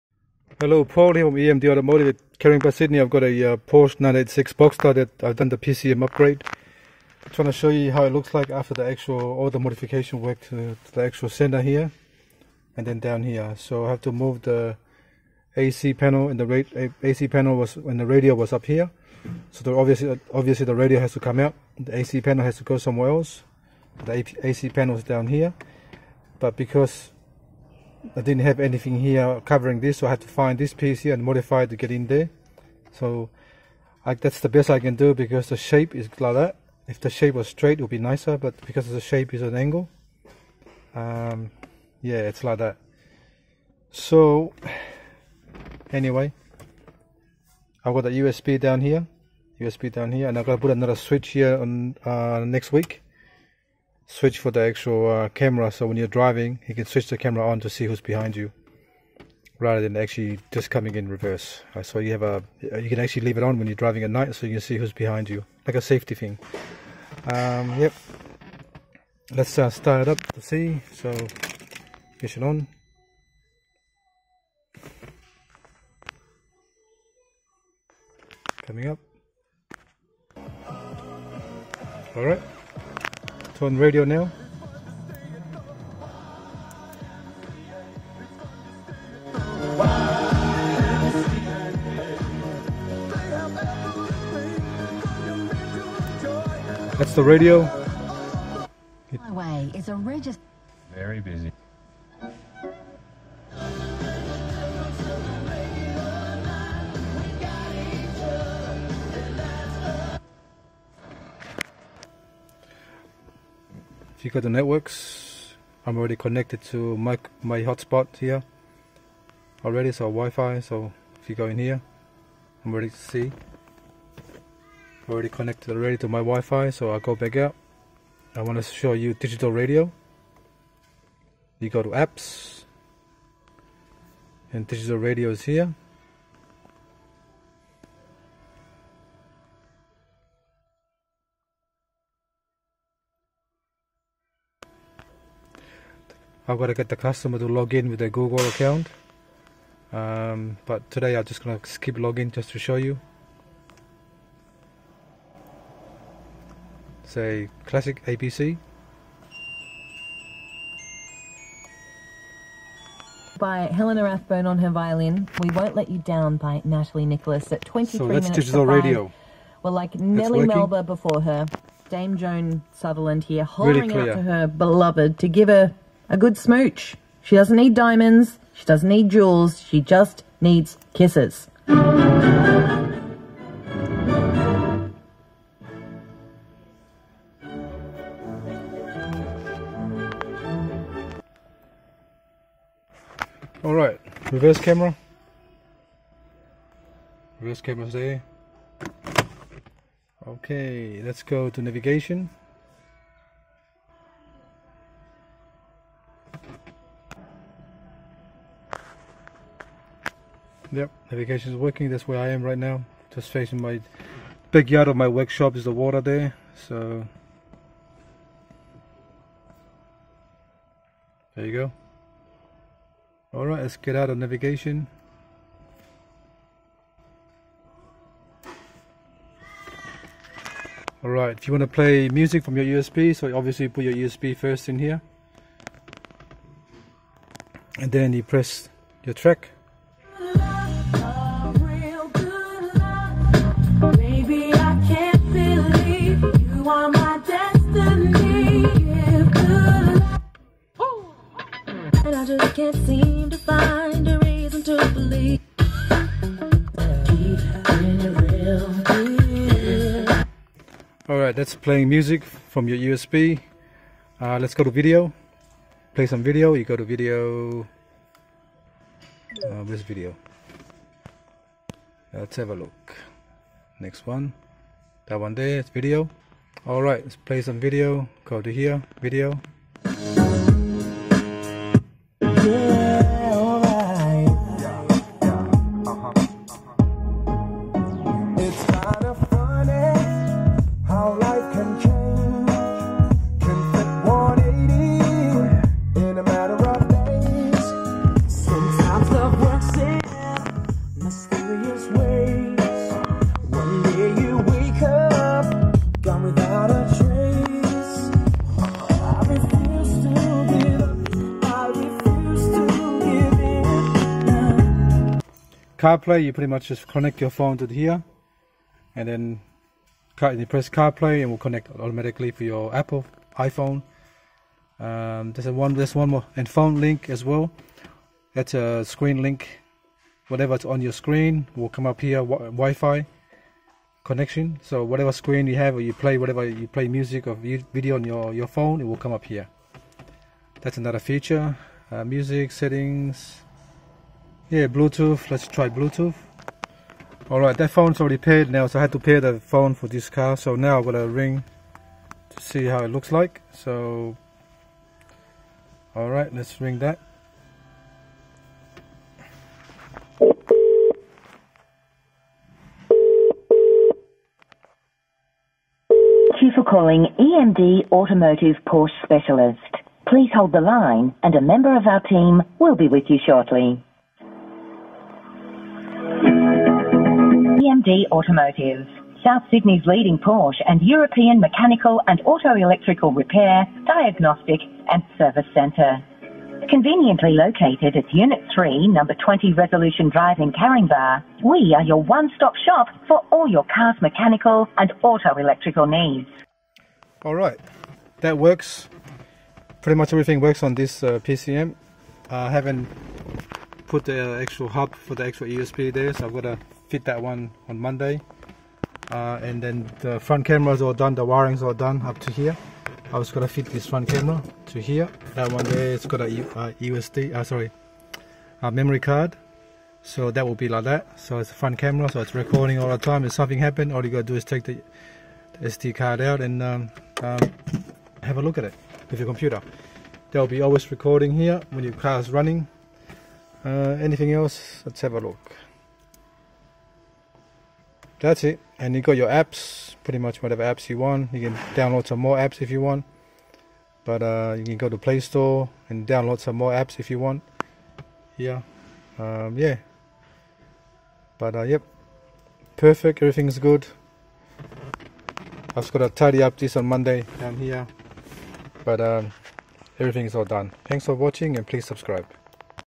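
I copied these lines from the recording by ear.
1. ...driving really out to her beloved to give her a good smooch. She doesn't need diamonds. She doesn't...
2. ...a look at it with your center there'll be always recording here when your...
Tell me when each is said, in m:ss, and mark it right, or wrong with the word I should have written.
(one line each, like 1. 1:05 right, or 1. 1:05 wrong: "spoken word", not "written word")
1. 2:53 wrong: "hollering", not "driving"
2. 7:08 wrong: "computer", not "center".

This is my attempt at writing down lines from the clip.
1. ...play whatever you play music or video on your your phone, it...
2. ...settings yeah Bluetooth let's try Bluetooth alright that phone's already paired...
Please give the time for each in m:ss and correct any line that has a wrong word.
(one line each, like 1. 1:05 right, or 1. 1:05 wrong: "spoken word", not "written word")
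1. 5:35 right
2. 5:42 right.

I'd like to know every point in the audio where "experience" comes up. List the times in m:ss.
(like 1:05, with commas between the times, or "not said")
not said.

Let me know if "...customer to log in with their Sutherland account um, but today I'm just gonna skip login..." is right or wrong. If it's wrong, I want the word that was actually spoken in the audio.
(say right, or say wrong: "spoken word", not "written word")
wrong: "Google", not "Sutherland".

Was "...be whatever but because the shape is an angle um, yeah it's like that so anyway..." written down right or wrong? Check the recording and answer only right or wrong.
wrong.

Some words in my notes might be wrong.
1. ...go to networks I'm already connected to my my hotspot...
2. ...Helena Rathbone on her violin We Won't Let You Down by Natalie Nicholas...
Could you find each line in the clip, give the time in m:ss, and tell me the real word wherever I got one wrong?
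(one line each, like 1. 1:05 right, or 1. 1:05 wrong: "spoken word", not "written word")
1. 1:54 right
2. 2:43 right.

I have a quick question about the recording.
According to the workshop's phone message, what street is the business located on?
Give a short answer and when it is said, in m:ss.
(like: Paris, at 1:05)
Resolution Drive, at 6:29.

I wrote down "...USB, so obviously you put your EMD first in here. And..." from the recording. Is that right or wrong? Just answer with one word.
wrong.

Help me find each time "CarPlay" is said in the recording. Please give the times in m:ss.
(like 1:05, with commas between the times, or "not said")
5:15, 5:20.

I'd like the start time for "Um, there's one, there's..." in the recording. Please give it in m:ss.
5:24.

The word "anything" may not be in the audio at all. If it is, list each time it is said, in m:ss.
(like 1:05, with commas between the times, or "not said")
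0:28, 7:14.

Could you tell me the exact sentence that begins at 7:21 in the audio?
You can download some more apps if you want.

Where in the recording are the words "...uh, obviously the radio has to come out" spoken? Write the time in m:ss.
0:20.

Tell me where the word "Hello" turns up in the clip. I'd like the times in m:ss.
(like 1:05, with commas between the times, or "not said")
0:00.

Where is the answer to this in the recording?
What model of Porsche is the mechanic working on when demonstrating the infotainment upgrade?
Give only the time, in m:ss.
0:03.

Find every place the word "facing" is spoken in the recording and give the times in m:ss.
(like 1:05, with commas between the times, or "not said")
3:33.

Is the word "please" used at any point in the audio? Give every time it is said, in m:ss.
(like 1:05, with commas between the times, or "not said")
6:10, 7:41.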